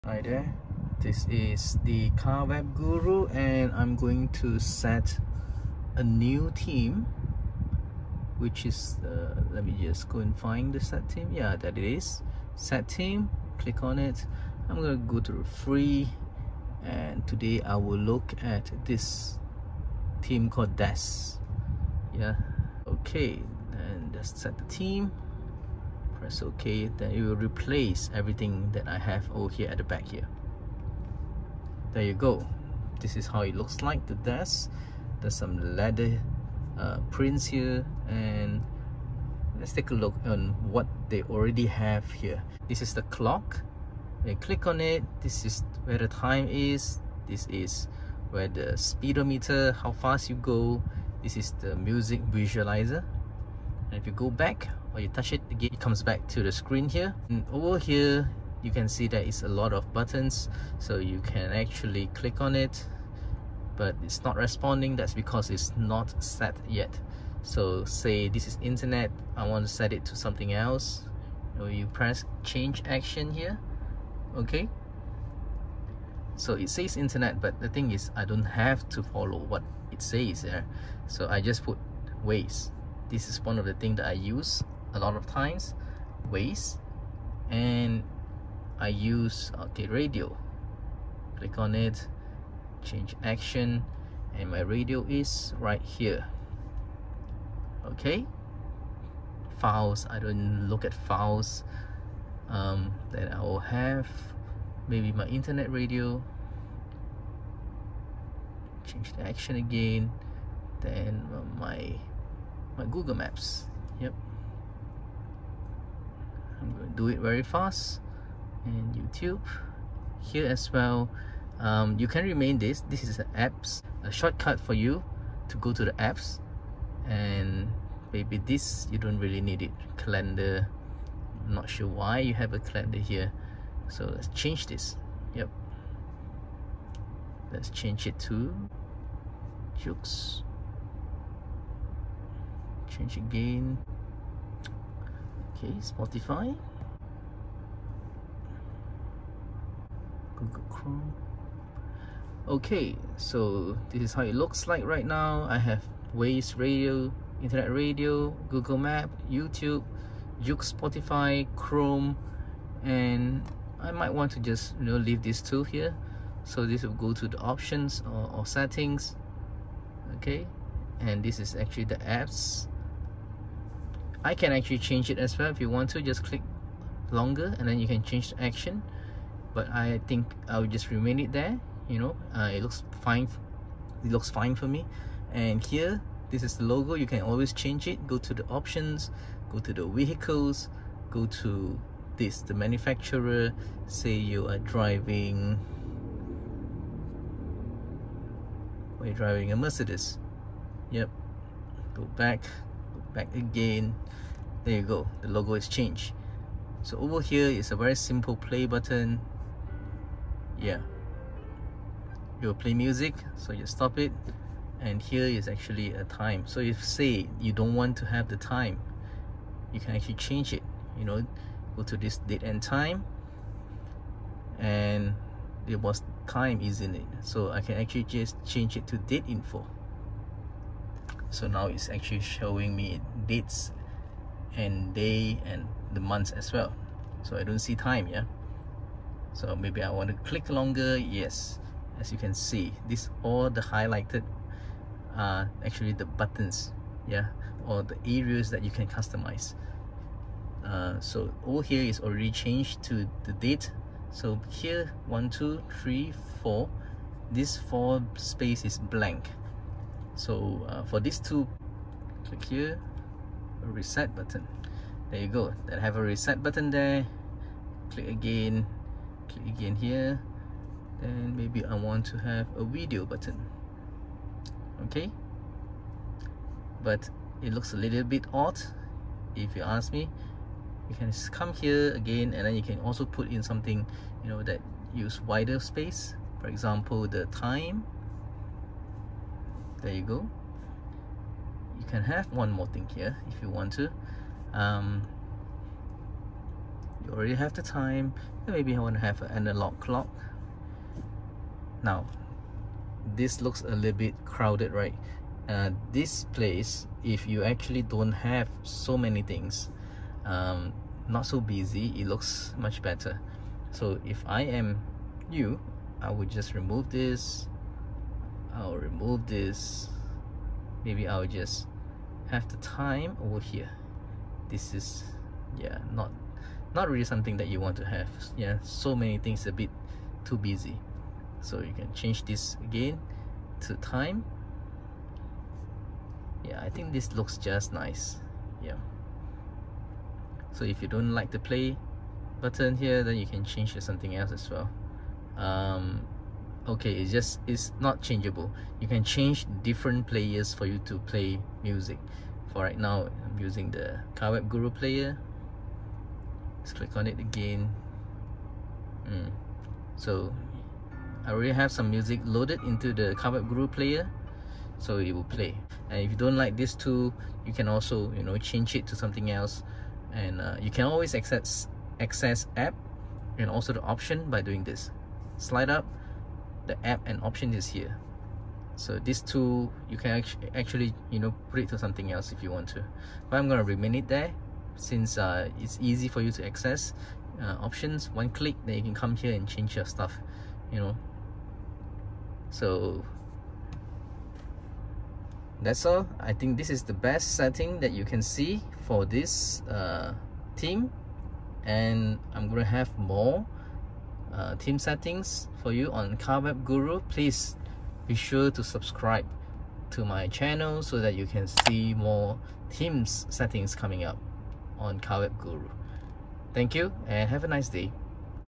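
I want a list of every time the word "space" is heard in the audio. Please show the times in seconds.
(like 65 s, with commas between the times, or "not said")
258 s, 285 s.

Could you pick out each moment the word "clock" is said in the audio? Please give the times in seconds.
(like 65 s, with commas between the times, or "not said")
43 s, 299 s.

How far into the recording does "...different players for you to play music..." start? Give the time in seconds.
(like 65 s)
349 s.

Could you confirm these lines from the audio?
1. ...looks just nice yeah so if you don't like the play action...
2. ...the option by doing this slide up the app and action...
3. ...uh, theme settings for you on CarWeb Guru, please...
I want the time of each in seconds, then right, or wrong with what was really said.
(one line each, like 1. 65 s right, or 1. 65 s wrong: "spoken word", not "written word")
1. 337 s wrong: "button", not "action"
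2. 373 s wrong: "option", not "action"
3. 404 s right.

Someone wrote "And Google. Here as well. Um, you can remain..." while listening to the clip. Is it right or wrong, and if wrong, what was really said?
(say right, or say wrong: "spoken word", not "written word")
wrong: "YouTube", not "Google".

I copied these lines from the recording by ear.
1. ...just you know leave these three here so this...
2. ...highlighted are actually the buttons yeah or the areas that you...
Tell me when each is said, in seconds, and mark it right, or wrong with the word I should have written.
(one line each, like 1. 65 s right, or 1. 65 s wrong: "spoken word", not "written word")
1. 164 s wrong: "two", not "three"
2. 243 s right.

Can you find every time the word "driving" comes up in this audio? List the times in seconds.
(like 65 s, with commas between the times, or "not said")
194 s, 199 s.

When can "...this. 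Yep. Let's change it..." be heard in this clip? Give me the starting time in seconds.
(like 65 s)
134 s.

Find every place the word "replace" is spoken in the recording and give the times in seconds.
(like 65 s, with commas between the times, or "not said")
27 s.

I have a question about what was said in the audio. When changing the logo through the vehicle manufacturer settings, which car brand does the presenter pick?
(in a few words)
Mercedes.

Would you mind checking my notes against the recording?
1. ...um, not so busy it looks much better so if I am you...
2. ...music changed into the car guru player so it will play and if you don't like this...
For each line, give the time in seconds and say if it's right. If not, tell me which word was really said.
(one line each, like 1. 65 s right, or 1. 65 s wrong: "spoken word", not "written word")
1. 310 s right
2. 361 s wrong: "loaded", not "changed".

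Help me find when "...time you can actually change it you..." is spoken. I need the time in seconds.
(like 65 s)
218 s.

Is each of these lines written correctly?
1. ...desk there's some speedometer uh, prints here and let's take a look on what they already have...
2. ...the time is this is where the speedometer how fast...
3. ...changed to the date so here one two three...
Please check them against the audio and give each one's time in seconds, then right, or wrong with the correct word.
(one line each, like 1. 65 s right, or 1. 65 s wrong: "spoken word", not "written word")
1. 34 s wrong: "leather", not "speedometer"
2. 45 s right
3. 252 s right.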